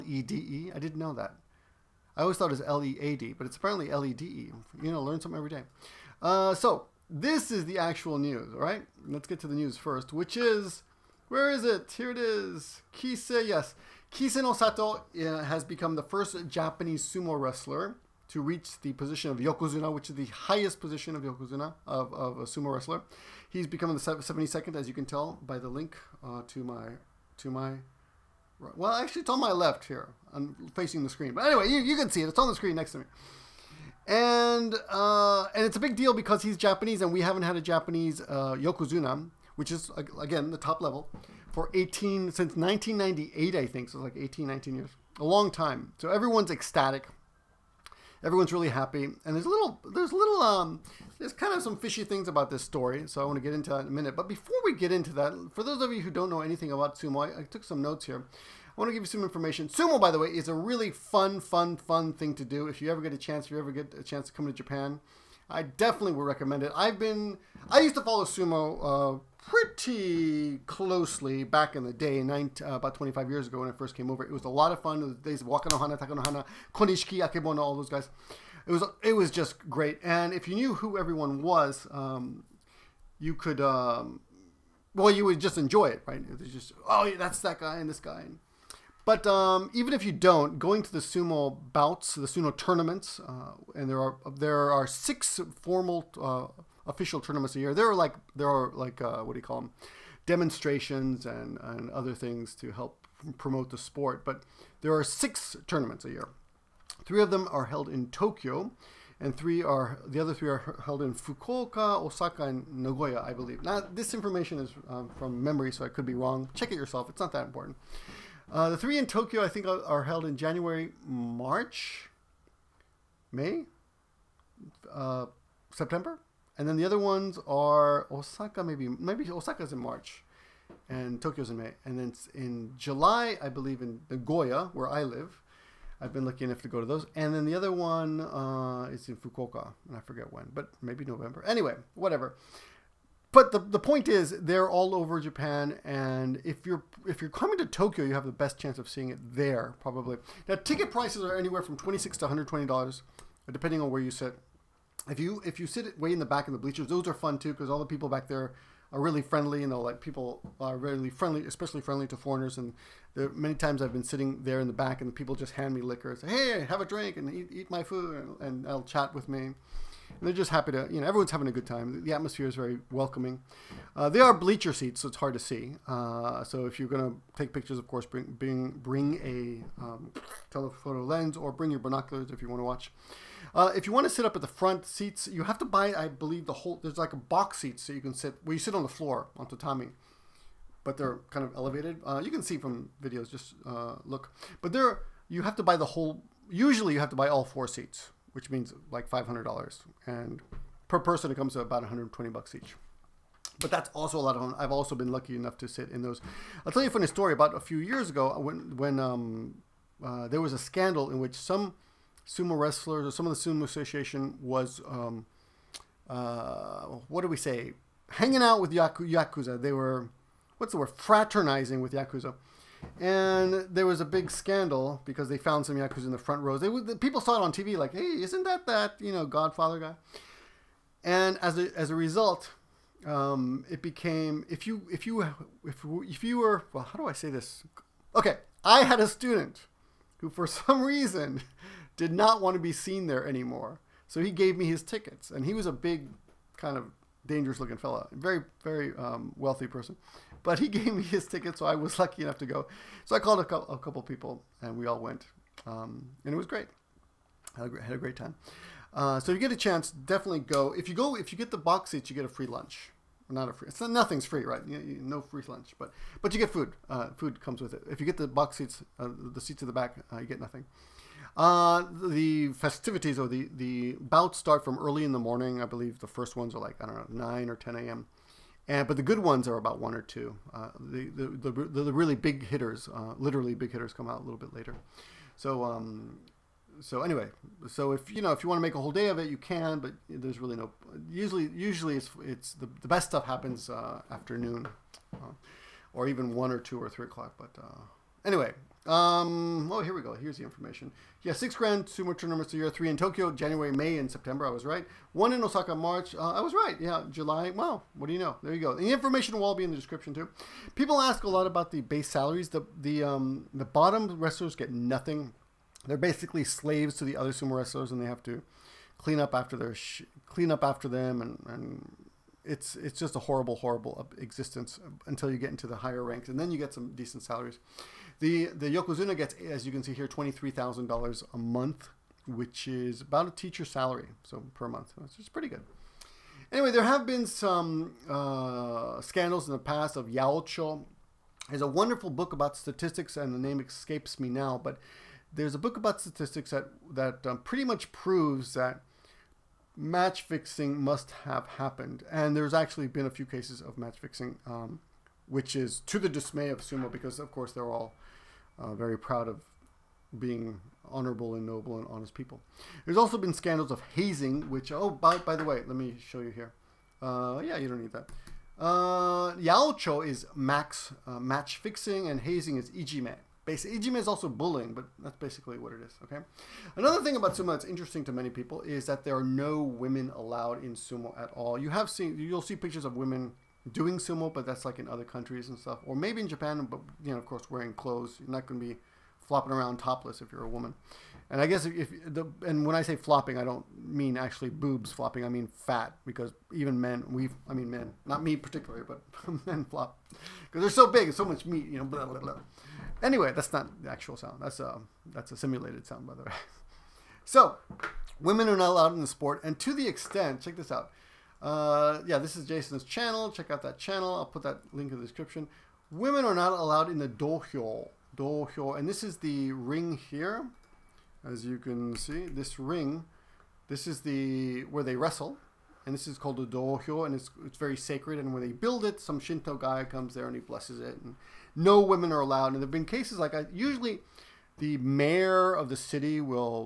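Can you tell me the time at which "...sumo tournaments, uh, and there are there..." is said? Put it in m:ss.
1:32.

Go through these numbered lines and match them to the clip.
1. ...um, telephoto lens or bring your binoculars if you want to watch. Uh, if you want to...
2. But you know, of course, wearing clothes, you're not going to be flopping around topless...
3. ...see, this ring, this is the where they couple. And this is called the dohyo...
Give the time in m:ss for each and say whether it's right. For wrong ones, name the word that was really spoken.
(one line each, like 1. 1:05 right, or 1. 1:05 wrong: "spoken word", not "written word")
1. 2:59 right
2. 6:26 right
3. 7:01 wrong: "wrestle", not "couple".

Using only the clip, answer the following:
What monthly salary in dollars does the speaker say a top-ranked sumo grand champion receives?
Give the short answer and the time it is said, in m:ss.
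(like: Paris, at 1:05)
$23,000, at 5:30.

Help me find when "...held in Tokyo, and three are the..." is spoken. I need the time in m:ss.
1:47.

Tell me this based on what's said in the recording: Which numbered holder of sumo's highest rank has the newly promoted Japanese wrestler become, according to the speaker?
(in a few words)
72nd.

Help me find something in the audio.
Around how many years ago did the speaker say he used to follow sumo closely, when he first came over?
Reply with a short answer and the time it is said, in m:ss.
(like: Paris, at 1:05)
25 years, at 1:12.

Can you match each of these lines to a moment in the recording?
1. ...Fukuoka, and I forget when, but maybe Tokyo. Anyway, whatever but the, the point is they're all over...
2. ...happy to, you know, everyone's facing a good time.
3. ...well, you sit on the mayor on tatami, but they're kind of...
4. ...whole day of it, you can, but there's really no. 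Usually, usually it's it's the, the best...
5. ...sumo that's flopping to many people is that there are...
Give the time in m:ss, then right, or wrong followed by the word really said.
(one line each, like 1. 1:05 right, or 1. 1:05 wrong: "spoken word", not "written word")
1. 2:19 wrong: "November", not "Tokyo"
2. 2:50 wrong: "having", not "facing"
3. 3:08 wrong: "floor", not "mayor"
4. 4:48 right
5. 6:17 wrong: "interesting", not "flopping".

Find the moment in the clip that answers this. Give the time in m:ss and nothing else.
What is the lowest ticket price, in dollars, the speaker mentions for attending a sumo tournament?
2:31.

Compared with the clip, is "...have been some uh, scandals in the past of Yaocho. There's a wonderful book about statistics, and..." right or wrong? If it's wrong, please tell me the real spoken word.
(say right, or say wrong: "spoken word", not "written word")
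right.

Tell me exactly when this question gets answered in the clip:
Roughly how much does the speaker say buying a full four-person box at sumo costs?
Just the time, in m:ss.
3:19.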